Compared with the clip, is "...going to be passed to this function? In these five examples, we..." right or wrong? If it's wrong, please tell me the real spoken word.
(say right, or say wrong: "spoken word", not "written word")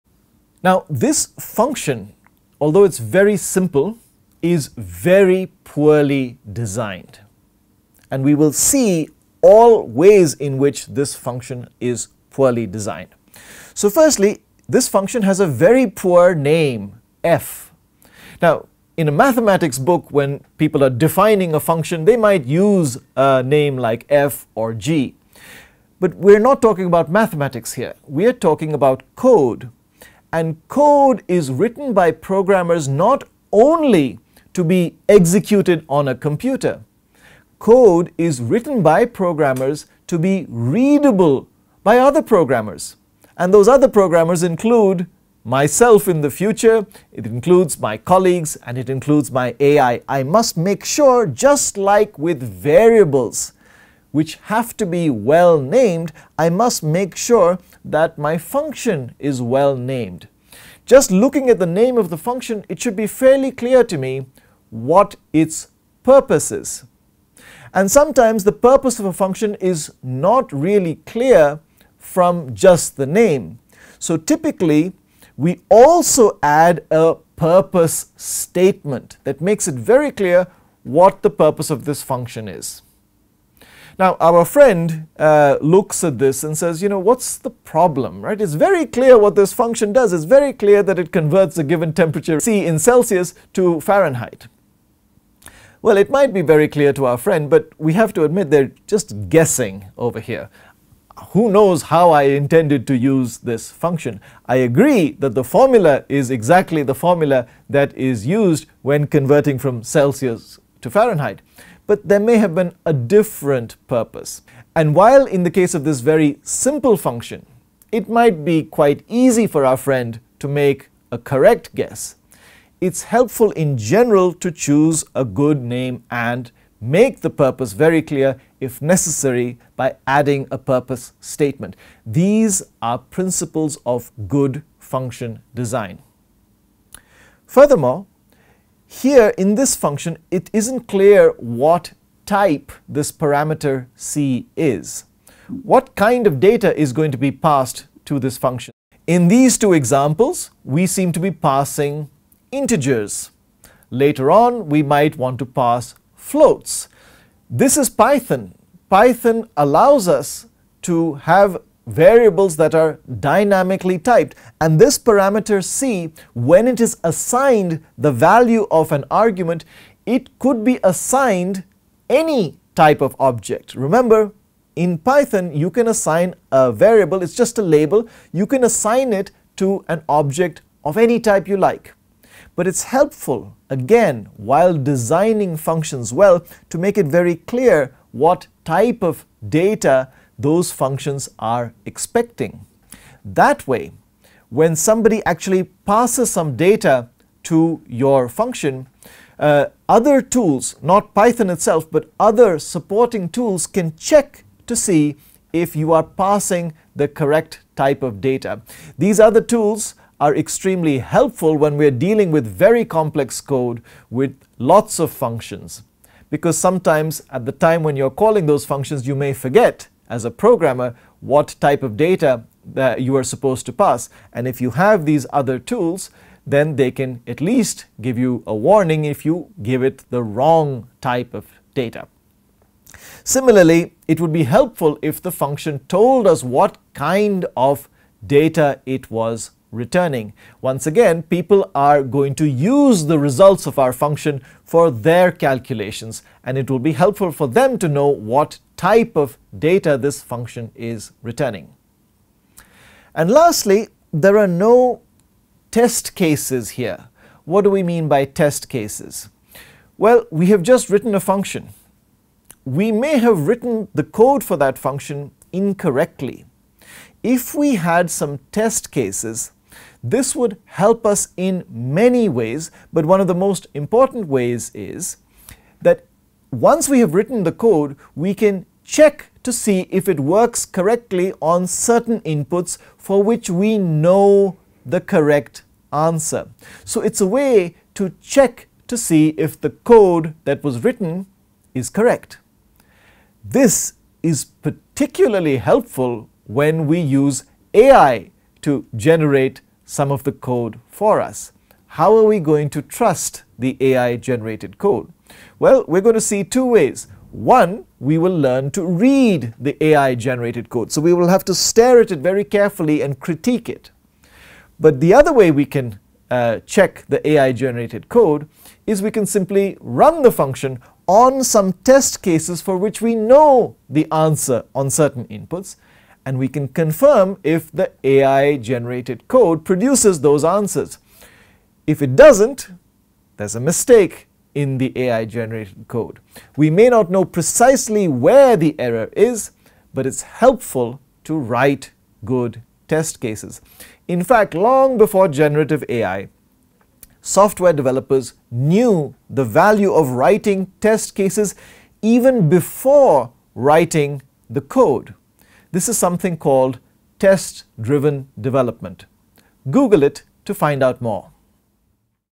wrong: "two", not "five".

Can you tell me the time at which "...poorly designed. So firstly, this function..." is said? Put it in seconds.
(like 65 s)
12 s.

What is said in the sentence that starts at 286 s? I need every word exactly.
So it's a way to check to see if the code that was written is correct.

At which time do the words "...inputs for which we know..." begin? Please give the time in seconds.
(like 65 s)
282 s.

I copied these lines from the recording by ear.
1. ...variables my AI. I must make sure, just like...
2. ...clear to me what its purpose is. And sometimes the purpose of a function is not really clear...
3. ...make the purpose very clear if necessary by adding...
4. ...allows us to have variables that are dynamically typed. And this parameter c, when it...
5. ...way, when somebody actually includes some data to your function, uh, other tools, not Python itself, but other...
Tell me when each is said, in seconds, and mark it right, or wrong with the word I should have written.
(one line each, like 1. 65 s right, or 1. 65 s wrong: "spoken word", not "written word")
1. 48 s wrong: "includes", not "variables"
2. 63 s right
3. 126 s right
4. 159 s right
5. 193 s wrong: "passes", not "includes".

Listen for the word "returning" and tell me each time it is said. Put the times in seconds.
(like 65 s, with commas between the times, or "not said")
239 s, 251 s.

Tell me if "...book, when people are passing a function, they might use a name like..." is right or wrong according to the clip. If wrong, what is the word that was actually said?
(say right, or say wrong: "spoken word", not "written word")
wrong: "defining", not "passing".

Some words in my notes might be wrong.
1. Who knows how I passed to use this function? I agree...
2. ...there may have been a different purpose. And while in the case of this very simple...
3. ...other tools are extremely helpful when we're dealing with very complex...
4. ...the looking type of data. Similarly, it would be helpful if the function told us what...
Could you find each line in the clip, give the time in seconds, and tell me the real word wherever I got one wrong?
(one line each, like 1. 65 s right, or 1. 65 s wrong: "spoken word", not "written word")
1. 101 s wrong: "intended", not "passed"
2. 112 s right
3. 209 s right
4. 230 s wrong: "wrong", not "looking".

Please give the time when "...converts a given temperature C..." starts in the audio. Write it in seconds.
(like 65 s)
91 s.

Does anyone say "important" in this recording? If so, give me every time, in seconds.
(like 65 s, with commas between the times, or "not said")
273 s.